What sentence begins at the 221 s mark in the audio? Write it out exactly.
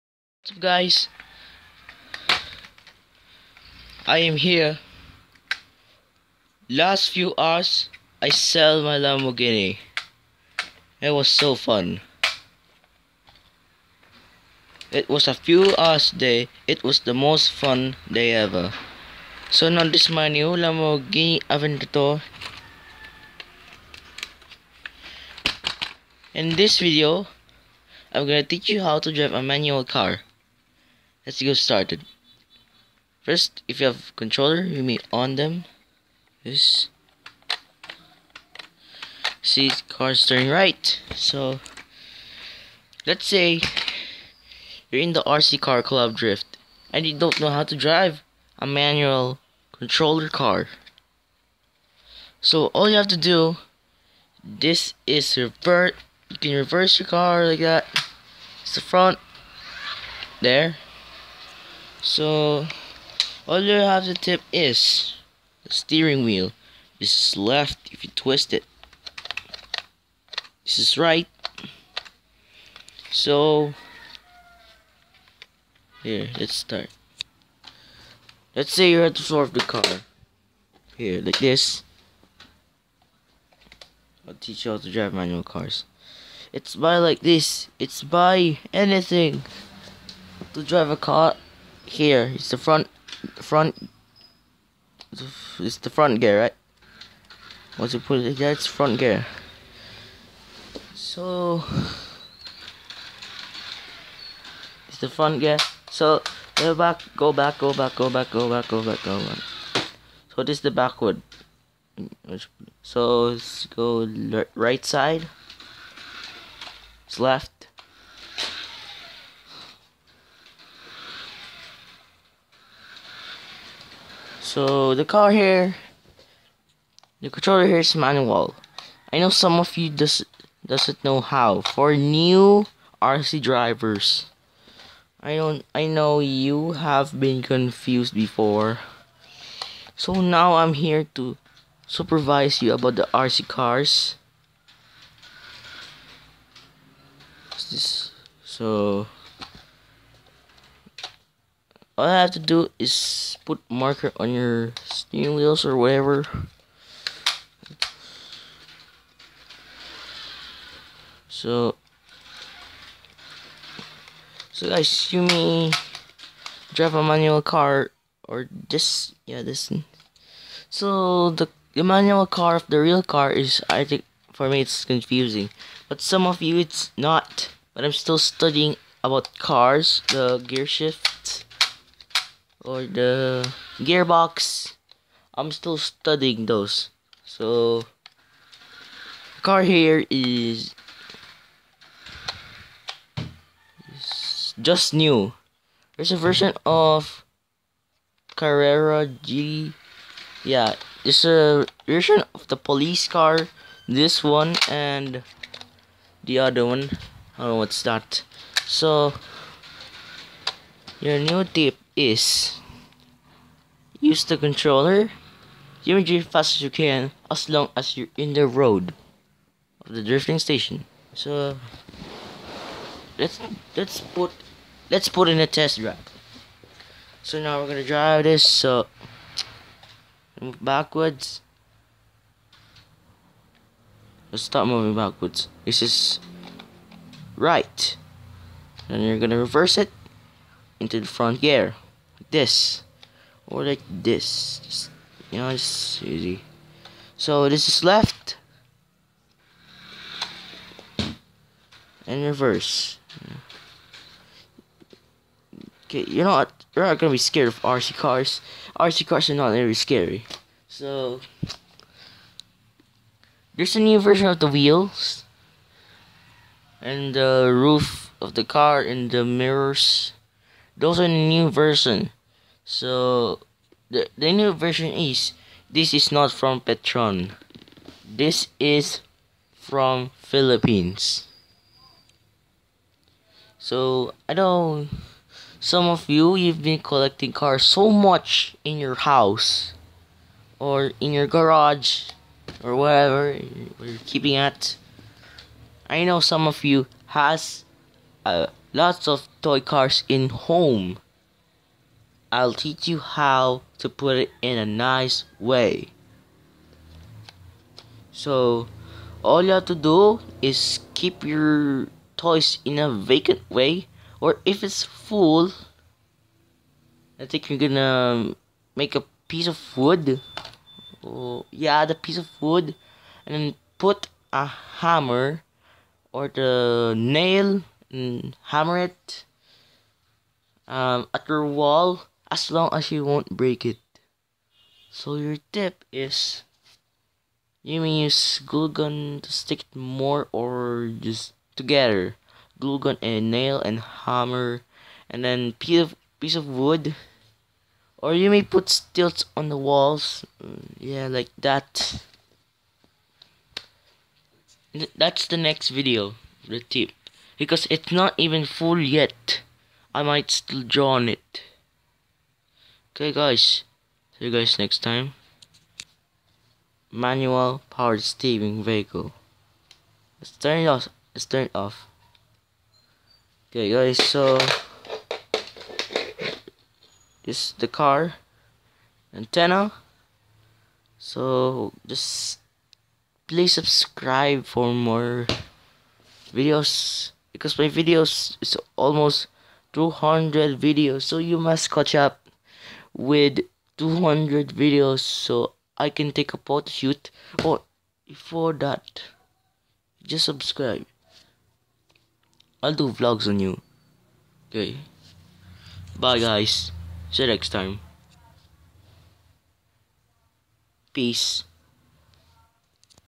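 So let's let's put let's put in a test drive.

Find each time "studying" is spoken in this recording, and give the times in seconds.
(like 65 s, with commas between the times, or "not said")
178 s, 185 s.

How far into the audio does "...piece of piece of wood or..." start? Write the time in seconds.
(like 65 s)
345 s.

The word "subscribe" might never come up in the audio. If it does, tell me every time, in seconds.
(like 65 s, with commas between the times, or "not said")
383 s, 400 s.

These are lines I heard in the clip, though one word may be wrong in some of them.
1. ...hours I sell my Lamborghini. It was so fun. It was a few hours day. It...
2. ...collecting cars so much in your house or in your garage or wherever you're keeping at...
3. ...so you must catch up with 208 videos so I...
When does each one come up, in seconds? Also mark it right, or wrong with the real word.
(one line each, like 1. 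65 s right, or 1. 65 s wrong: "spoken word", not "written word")
1. 7 s right
2. 286 s right
3. 391 s wrong: "200", not "208".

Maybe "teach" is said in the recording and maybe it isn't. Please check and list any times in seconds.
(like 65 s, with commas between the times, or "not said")
28 s, 84 s, 302 s.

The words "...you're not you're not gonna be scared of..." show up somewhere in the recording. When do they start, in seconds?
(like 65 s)
256 s.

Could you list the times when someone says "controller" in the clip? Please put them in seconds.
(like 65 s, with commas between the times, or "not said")
34 s, 49 s, 127 s, 214 s.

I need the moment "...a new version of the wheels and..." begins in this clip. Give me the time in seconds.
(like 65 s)
263 s.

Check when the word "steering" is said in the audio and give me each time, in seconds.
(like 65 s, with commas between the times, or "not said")
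65 s, 154 s, 368 s.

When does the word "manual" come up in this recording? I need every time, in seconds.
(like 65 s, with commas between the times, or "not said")
29 s, 48 s, 85 s, 127 s, 167 s, 171 s, 366 s.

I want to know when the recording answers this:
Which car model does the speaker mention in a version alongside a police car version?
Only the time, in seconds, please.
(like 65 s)
198 s.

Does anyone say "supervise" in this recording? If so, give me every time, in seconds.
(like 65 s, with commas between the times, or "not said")
141 s.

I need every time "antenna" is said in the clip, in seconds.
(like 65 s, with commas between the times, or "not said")
379 s.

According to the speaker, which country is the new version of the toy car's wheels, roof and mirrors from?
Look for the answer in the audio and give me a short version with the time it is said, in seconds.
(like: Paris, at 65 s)
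Philippines, at 280 s.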